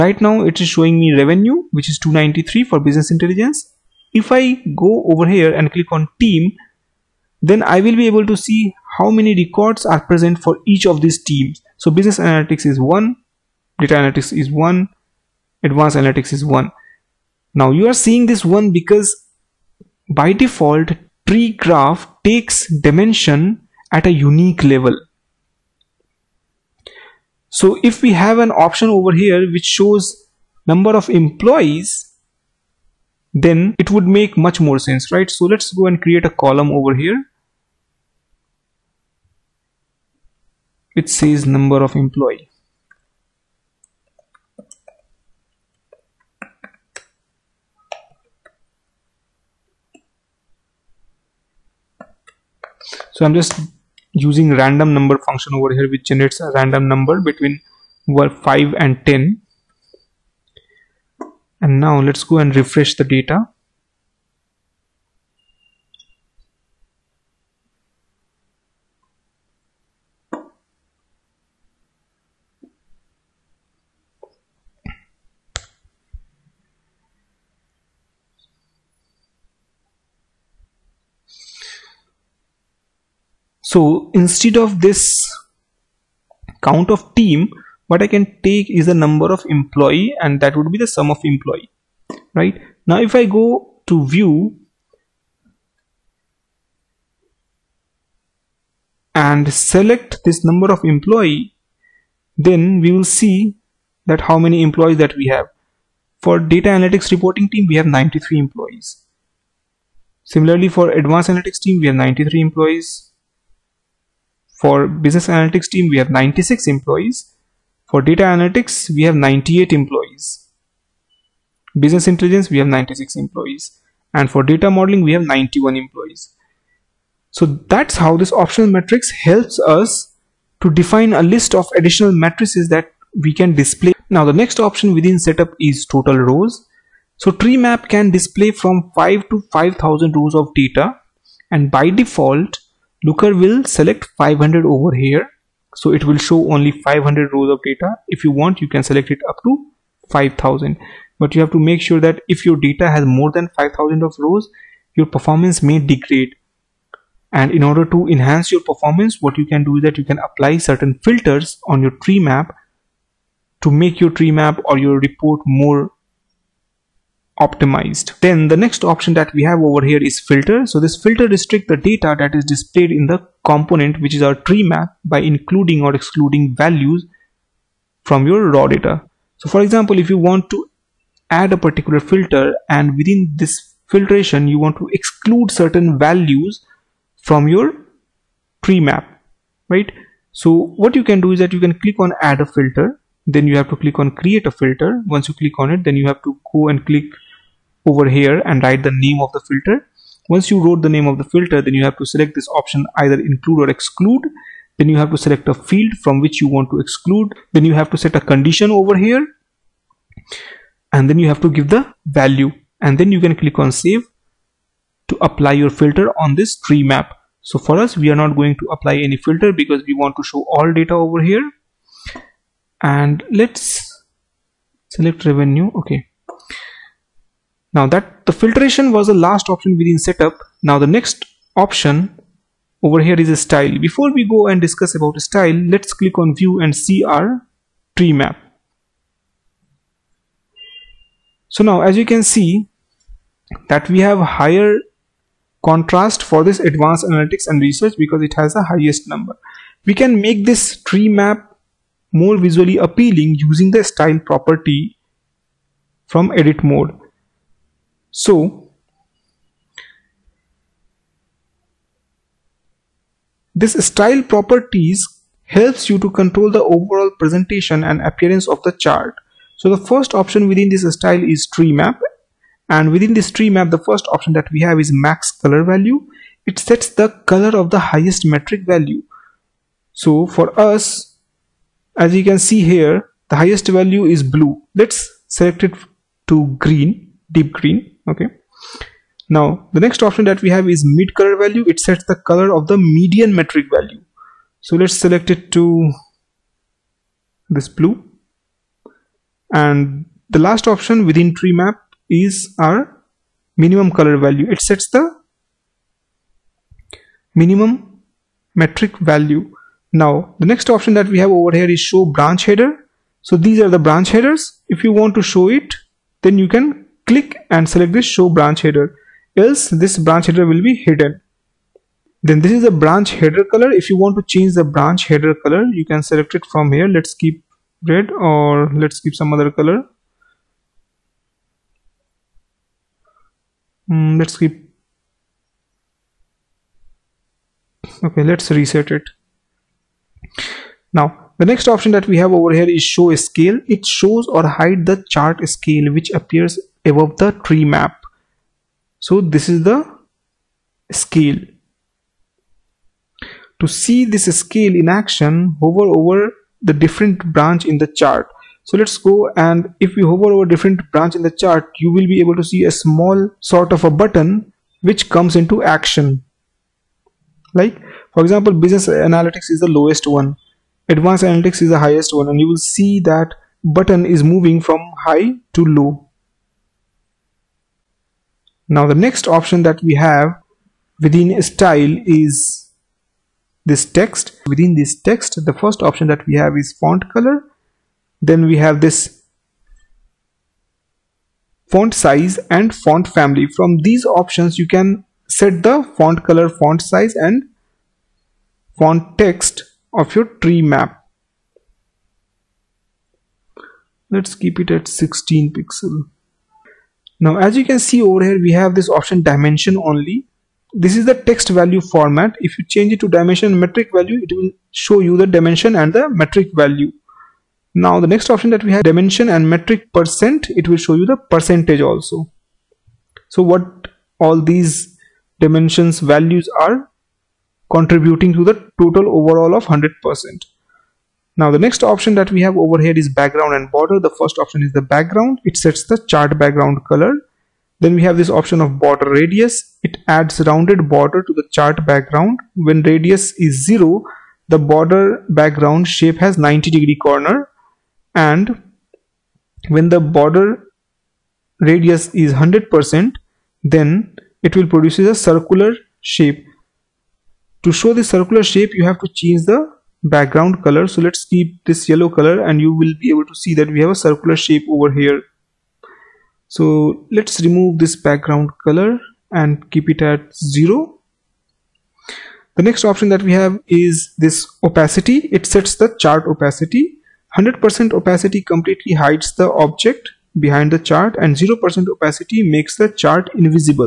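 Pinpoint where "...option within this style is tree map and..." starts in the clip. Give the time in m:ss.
4:30.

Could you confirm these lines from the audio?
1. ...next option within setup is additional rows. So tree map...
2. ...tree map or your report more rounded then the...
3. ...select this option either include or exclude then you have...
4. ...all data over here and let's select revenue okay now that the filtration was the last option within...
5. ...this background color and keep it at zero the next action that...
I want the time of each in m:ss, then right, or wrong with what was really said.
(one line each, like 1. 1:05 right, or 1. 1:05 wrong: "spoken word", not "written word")
1. 2:14 wrong: "total", not "additional"
2. 2:44 wrong: "optimized", not "rounded"
3. 3:22 right
4. 3:40 right
5. 7:47 wrong: "option", not "action".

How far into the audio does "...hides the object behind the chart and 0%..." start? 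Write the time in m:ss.
7:58.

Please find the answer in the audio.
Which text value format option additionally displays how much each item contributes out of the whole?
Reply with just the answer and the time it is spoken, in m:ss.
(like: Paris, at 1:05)
Dimension and metric percent, at 6:58.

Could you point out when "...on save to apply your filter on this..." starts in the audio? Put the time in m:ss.
3:33.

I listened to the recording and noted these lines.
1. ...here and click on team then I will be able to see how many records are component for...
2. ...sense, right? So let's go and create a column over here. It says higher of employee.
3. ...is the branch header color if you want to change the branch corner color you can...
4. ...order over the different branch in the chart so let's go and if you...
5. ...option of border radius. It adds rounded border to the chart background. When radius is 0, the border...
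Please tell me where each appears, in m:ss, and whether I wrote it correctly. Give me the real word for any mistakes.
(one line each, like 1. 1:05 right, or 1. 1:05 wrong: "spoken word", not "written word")
1. 0:05 wrong: "present", not "component"
2. 0:34 wrong: "number", not "higher"
3. 5:22 wrong: "header", not "corner"
4. 5:55 wrong: "hover", not "order"
5. 7:18 right.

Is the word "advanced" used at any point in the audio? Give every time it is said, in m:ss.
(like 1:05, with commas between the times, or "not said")
0:15, 1:51, 4:06, 6:10.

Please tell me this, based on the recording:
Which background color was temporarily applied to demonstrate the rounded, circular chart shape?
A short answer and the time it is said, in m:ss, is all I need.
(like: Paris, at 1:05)
Yellow, at 7:41.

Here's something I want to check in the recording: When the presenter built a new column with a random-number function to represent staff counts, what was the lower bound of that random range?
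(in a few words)
5.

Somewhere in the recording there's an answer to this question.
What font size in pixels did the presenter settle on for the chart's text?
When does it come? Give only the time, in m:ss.
6:44.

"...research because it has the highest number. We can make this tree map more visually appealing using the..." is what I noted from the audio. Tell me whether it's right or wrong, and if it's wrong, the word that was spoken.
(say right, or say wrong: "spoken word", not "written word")
right.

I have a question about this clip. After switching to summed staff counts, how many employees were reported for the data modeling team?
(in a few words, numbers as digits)
91.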